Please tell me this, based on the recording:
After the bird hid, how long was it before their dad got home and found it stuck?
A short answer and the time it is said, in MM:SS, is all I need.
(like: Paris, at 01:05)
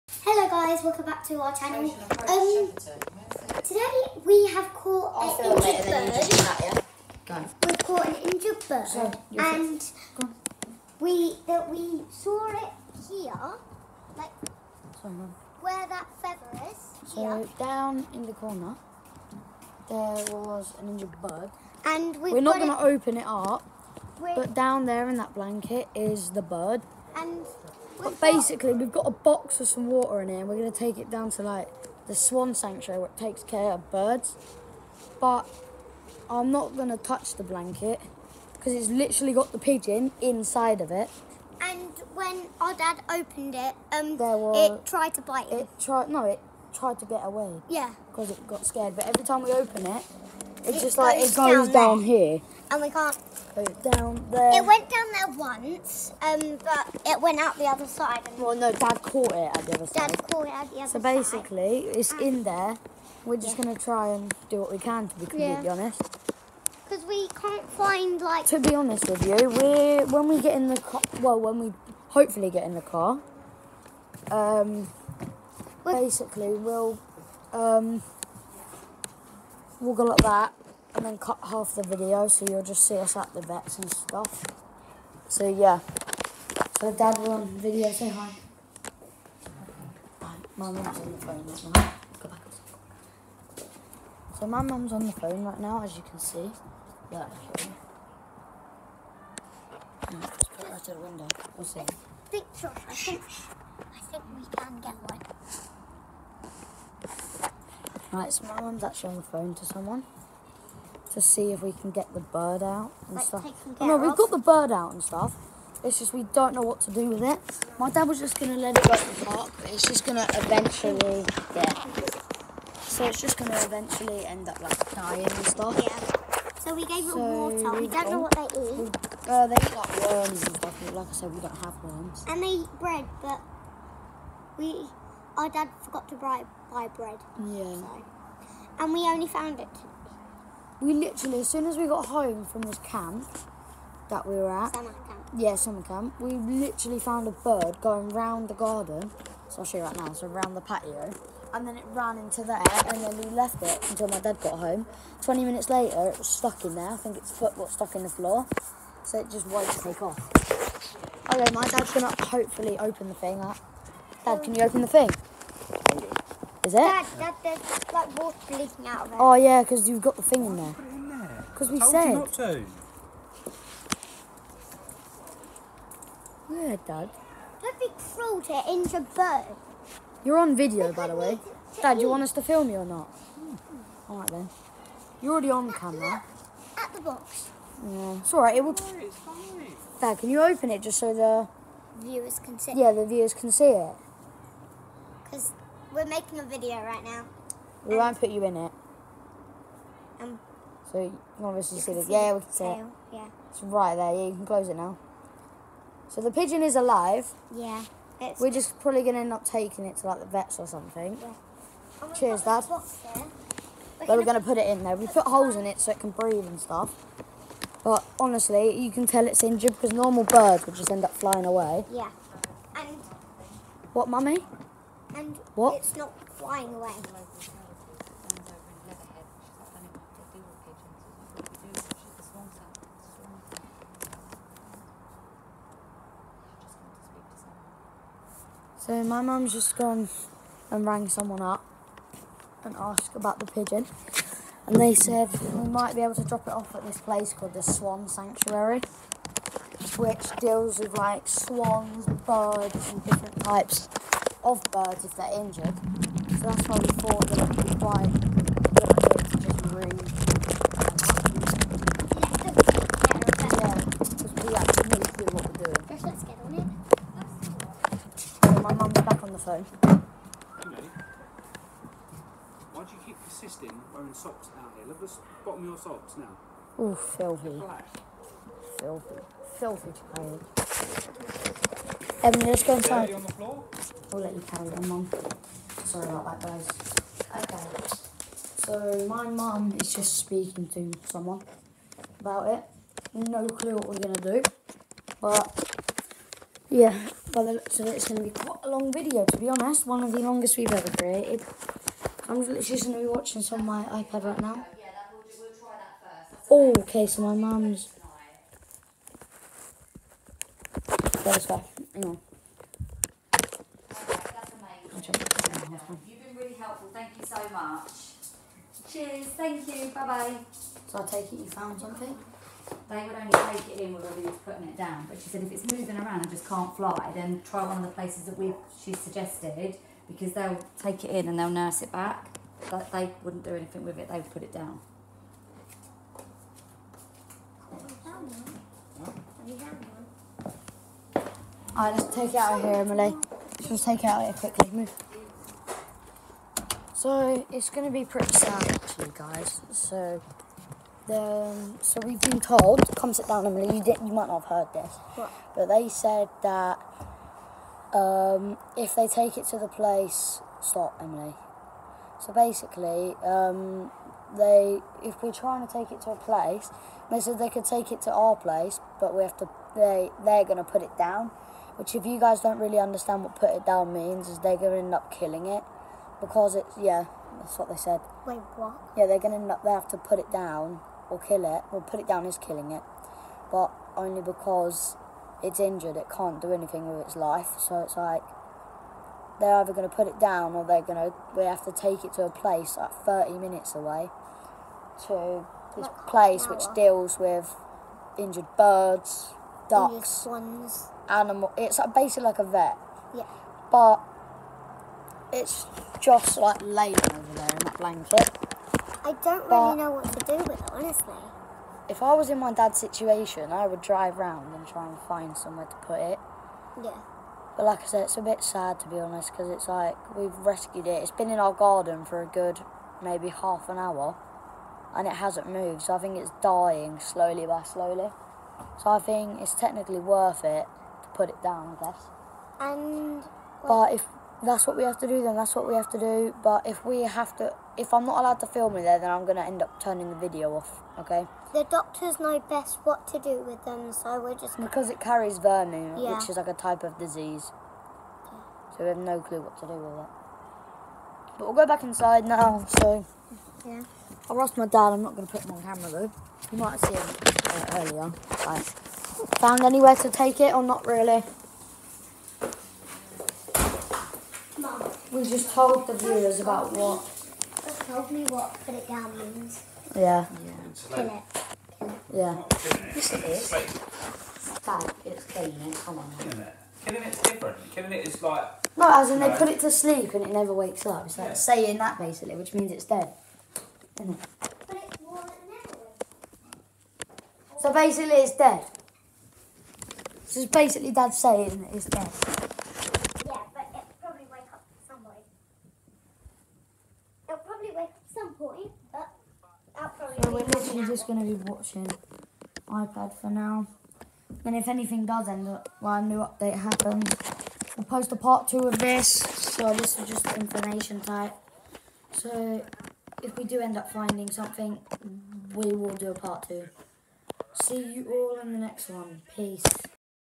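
20 minutes, at 02:35.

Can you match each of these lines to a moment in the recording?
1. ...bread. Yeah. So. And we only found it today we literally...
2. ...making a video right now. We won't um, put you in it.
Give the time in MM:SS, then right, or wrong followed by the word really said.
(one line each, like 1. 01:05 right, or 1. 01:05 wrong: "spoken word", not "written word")
1. 02:16 right
2. 03:16 right.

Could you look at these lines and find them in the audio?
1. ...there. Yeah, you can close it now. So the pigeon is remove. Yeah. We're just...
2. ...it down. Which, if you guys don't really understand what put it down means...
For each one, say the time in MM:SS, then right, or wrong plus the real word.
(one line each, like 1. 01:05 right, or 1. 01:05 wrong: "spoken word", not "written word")
1. 03:23 wrong: "alive", not "remove"
2. 06:10 right.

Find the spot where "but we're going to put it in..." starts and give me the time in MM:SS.
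03:32.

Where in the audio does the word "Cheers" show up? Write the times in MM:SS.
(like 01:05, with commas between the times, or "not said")
03:32, 05:18.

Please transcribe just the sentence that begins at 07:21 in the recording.
The doctors know best what to do with them, so we're just.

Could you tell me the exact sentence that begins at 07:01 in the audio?
It's been in our garden for a good maybe half an hour and it hasn't moved.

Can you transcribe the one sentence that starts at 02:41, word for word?
Okay, my dad's gonna hopefully open the thing up.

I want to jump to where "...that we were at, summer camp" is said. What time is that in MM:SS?
02:24.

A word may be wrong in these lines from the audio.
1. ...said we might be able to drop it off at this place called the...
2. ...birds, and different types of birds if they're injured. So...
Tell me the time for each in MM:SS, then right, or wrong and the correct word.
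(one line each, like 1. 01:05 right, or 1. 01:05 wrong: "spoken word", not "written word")
1. 04:04 right
2. 04:12 right.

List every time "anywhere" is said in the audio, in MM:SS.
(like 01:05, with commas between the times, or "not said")
07:39.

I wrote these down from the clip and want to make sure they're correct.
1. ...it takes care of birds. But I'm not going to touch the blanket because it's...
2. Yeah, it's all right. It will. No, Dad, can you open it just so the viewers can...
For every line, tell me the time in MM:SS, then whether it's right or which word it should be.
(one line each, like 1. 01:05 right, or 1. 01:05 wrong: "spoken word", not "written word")
1. 00:33 right
2. 03:07 right.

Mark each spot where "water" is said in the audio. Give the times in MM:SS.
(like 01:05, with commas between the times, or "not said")
00:29, 02:07, 02:48.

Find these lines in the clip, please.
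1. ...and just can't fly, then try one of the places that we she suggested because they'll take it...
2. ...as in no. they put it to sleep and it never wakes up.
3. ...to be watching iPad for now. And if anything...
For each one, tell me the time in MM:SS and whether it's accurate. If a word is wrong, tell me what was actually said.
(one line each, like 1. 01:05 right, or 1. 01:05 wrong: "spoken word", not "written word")
1. 05:26 right
2. 07:59 right
3. 08:21 right.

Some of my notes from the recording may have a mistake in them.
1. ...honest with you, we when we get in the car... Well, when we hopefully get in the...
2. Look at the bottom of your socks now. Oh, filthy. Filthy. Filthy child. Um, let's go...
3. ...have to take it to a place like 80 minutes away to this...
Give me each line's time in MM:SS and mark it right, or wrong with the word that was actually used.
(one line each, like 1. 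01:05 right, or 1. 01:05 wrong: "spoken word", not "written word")
1. 01:08 right
2. 04:34 right
3. 06:31 wrong: "30", not "80".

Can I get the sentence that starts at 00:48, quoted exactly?
But every time we open it, it's it just like it goes down, down here.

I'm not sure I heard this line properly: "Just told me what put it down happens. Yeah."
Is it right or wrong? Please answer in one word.
wrong.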